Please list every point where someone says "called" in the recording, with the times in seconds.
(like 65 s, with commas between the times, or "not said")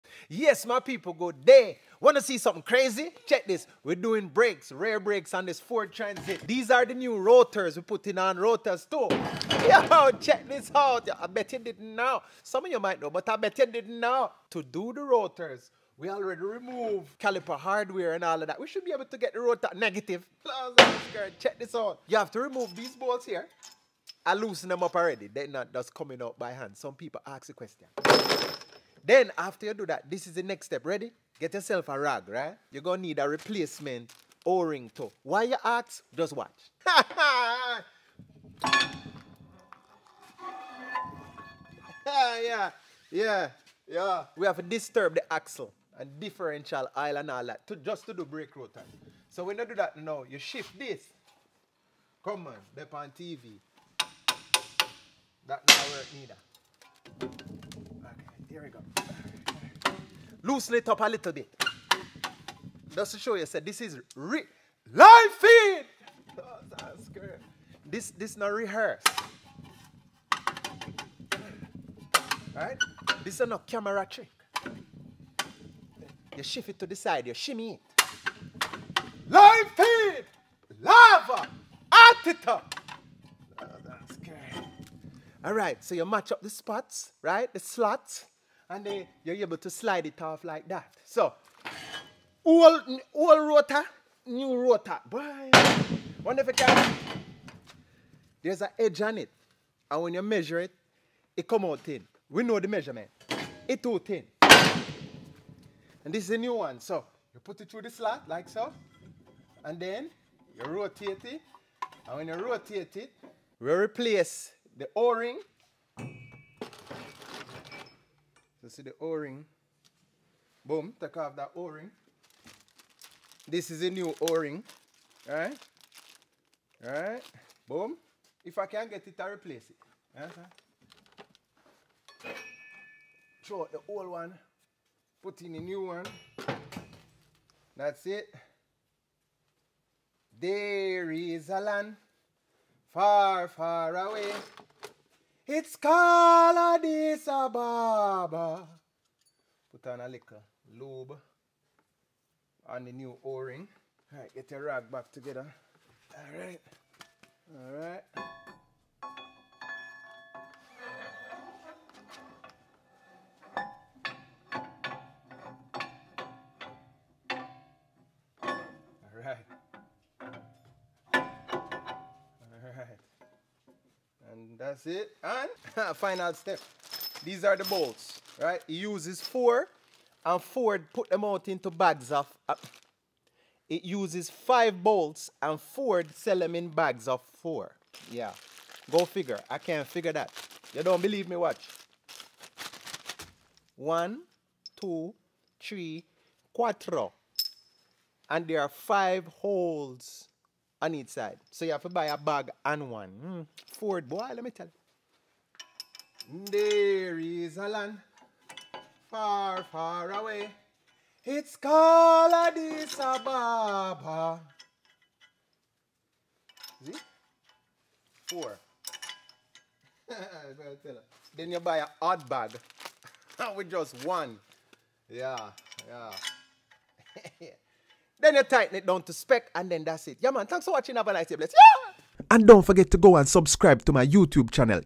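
145 s, 211 s.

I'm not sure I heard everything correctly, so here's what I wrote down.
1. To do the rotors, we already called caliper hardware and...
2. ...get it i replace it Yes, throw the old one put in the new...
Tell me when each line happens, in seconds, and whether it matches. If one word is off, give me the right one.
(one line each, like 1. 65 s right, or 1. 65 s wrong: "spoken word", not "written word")
1. 14 s wrong: "removed", not "called"
2. 128 s right.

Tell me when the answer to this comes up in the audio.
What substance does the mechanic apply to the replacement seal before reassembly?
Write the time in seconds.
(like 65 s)
150 s.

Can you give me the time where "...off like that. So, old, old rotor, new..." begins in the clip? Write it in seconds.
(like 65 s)
90 s.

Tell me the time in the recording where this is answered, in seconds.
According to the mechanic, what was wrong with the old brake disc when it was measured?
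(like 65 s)
103 s.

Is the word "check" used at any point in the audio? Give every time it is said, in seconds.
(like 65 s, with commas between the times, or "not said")
3 s, 10 s, 21 s.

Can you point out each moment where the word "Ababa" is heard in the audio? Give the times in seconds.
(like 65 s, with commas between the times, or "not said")
147 s, 212 s.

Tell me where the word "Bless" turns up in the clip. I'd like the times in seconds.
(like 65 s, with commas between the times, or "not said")
231 s.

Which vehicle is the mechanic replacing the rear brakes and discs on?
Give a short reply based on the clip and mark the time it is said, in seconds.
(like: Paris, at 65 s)
Ford Transit, at 5 s.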